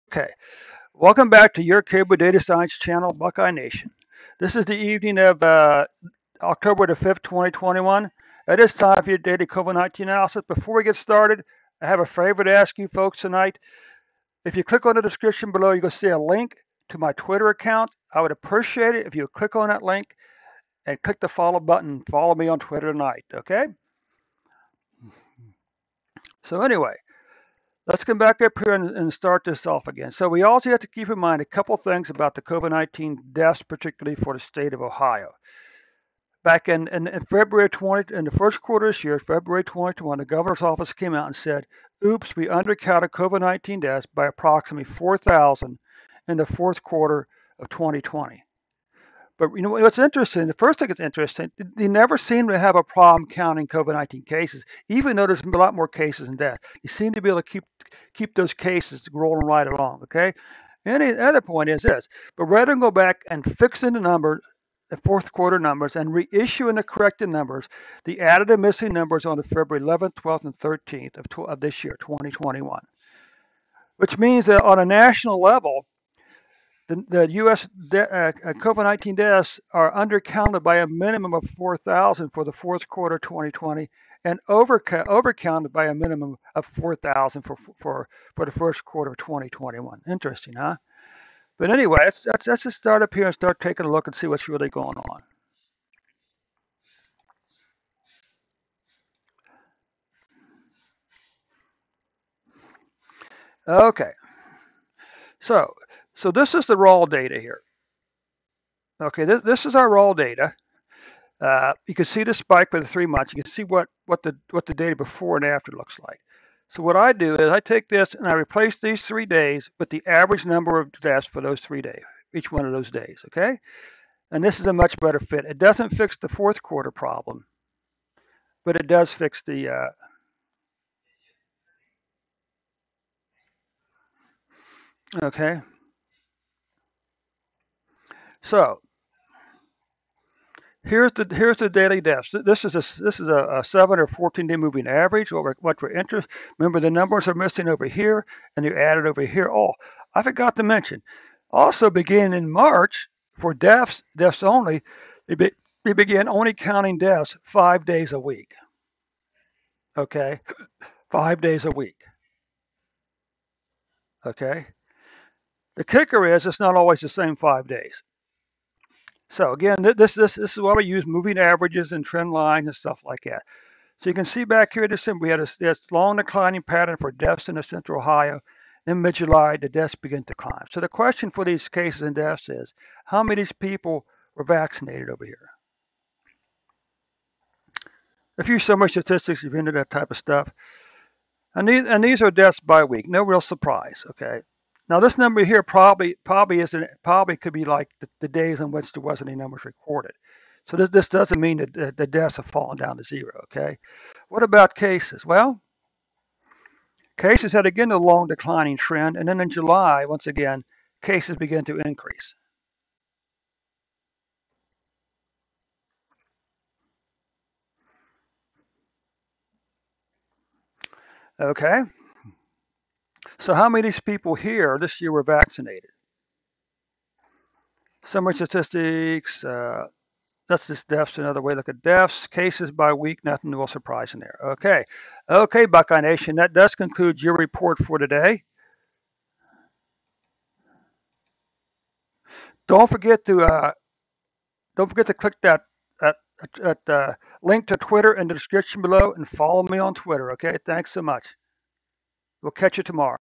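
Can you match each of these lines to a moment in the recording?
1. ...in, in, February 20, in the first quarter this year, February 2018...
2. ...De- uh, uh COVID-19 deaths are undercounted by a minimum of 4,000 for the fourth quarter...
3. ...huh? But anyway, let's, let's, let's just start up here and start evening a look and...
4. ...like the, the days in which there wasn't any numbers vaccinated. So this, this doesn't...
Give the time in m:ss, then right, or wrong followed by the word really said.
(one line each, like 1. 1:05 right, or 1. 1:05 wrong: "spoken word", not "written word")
1. 0:36 wrong: "2021", not "2018"
2. 1:17 right
3. 1:30 wrong: "taking", not "evening"
4. 3:17 wrong: "recorded", not "vaccinated".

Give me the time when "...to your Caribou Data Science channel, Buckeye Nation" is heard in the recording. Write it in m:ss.
0:01.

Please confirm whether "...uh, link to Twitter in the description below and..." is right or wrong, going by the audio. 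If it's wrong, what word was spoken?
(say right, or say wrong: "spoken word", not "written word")
right.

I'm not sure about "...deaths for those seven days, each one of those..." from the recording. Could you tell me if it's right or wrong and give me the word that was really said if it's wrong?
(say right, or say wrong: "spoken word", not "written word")
wrong: "three", not "seven".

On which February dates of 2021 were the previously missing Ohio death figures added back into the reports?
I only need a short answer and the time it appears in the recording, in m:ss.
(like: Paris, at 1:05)
February 11th, 12th, and 13th, at 1:09.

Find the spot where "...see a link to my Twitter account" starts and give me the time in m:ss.
0:15.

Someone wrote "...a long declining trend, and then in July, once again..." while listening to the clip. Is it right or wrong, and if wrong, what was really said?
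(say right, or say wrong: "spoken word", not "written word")
right.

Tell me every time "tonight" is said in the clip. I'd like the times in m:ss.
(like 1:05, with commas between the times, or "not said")
0:13, 0:22.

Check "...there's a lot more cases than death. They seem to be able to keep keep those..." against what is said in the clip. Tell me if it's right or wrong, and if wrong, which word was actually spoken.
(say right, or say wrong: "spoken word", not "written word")
right.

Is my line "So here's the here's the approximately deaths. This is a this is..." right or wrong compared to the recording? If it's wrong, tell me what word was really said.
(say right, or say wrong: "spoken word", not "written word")
wrong: "daily", not "approximately".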